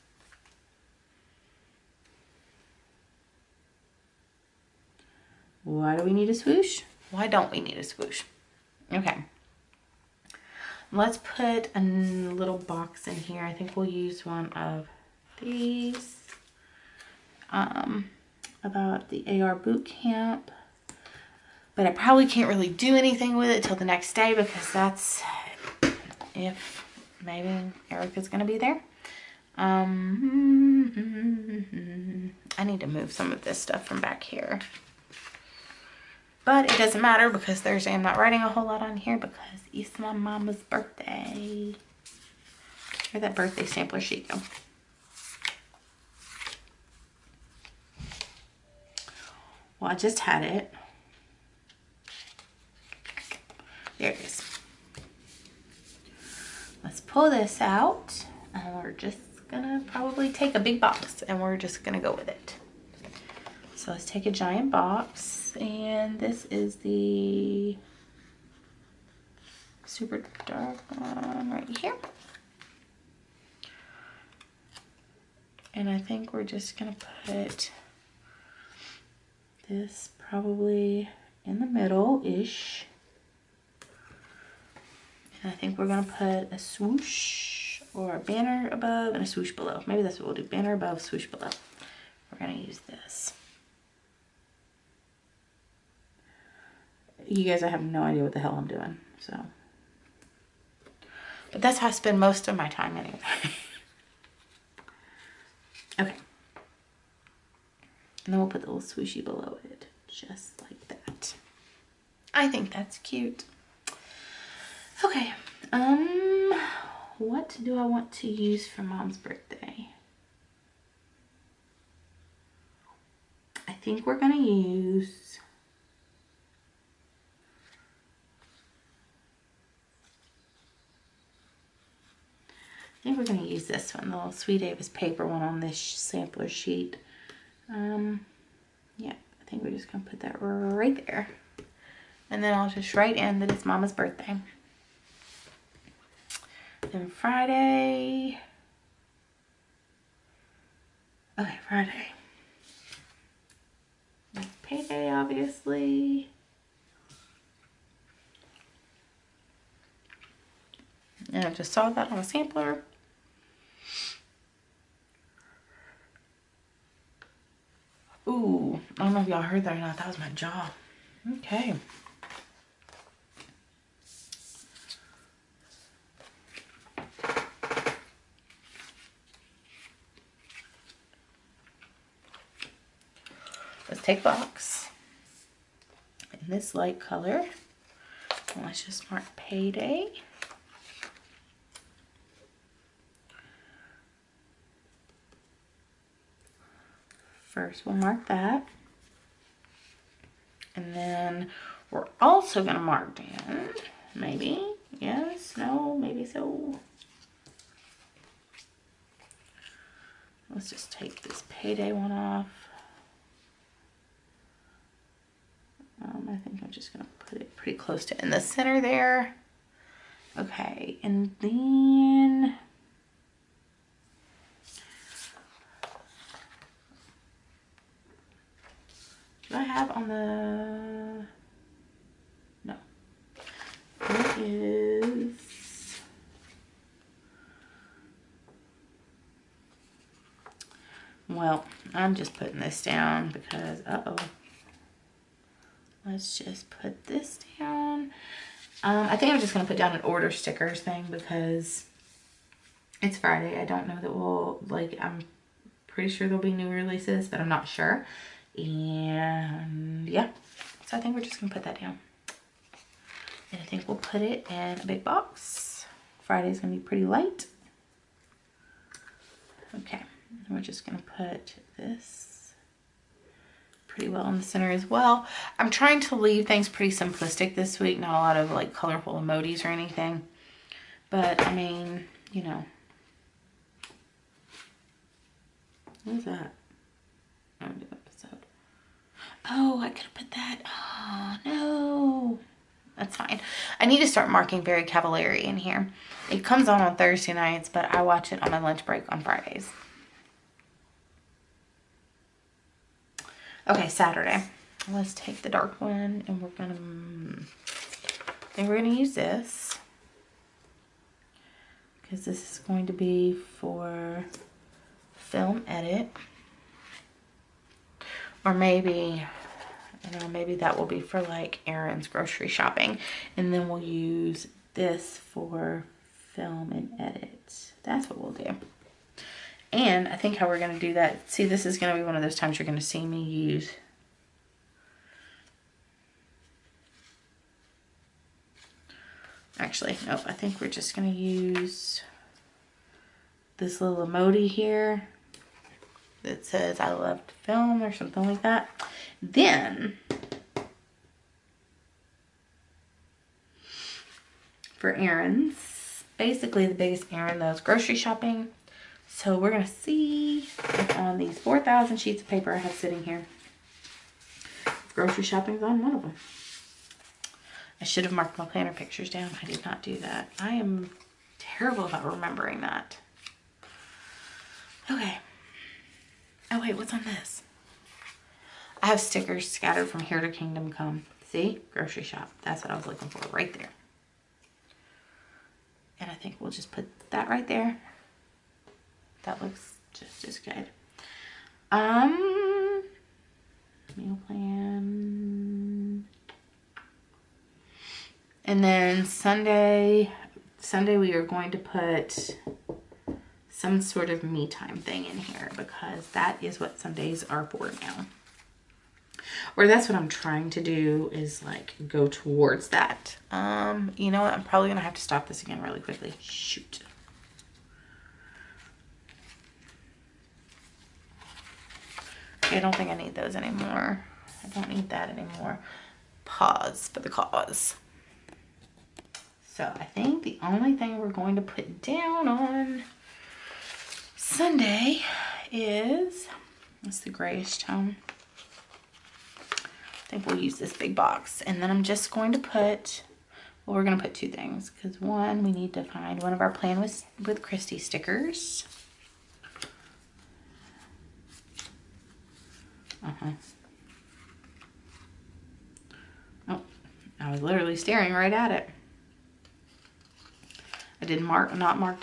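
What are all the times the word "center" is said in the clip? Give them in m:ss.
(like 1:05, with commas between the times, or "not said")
3:38, 4:34.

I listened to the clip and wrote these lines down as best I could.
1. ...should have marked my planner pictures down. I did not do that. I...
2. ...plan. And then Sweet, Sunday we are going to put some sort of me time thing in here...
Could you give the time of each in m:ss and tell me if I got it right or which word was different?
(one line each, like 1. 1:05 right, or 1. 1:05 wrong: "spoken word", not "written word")
1. 6:07 right
2. 6:34 wrong: "Sunday", not "Sweet".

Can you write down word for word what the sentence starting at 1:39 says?
So, but that's how I spend most of my time anyway.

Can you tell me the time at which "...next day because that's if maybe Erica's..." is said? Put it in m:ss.
0:23.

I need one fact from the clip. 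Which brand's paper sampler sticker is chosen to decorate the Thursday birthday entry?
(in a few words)
Sweet Davis.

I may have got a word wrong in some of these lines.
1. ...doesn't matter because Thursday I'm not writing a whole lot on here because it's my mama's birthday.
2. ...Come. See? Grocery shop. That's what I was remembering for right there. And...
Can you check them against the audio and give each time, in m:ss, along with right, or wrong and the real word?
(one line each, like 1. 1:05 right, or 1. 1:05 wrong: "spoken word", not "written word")
1. 0:36 right
2. 6:20 wrong: "looking", not "remembering".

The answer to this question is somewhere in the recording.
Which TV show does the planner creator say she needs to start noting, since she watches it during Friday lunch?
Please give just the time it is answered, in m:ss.
4:54.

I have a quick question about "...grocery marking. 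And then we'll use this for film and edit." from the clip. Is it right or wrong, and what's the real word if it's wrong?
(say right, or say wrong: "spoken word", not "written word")
wrong: "shopping", not "marking".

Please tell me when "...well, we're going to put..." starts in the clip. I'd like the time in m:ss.
7:23.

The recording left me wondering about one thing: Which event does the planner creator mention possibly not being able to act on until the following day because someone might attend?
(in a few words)
AR boot camp.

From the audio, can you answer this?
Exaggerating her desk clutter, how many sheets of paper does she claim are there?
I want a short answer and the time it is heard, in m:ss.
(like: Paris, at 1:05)
4,000, at 6:01.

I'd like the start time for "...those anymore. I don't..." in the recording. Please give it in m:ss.
7:03.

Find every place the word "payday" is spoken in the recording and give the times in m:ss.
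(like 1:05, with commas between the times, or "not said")
2:34, 3:09, 3:31.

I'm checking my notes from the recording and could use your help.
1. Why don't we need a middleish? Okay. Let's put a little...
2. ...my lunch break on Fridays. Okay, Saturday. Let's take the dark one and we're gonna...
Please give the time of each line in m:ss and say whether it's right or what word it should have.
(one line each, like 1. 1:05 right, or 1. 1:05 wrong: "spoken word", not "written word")
1. 0:07 wrong: "swoosh", not "middleish"
2. 4:58 right.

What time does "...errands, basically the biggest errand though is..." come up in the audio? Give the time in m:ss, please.
5:54.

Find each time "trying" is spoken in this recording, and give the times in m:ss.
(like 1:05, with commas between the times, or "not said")
4:35, 6:50.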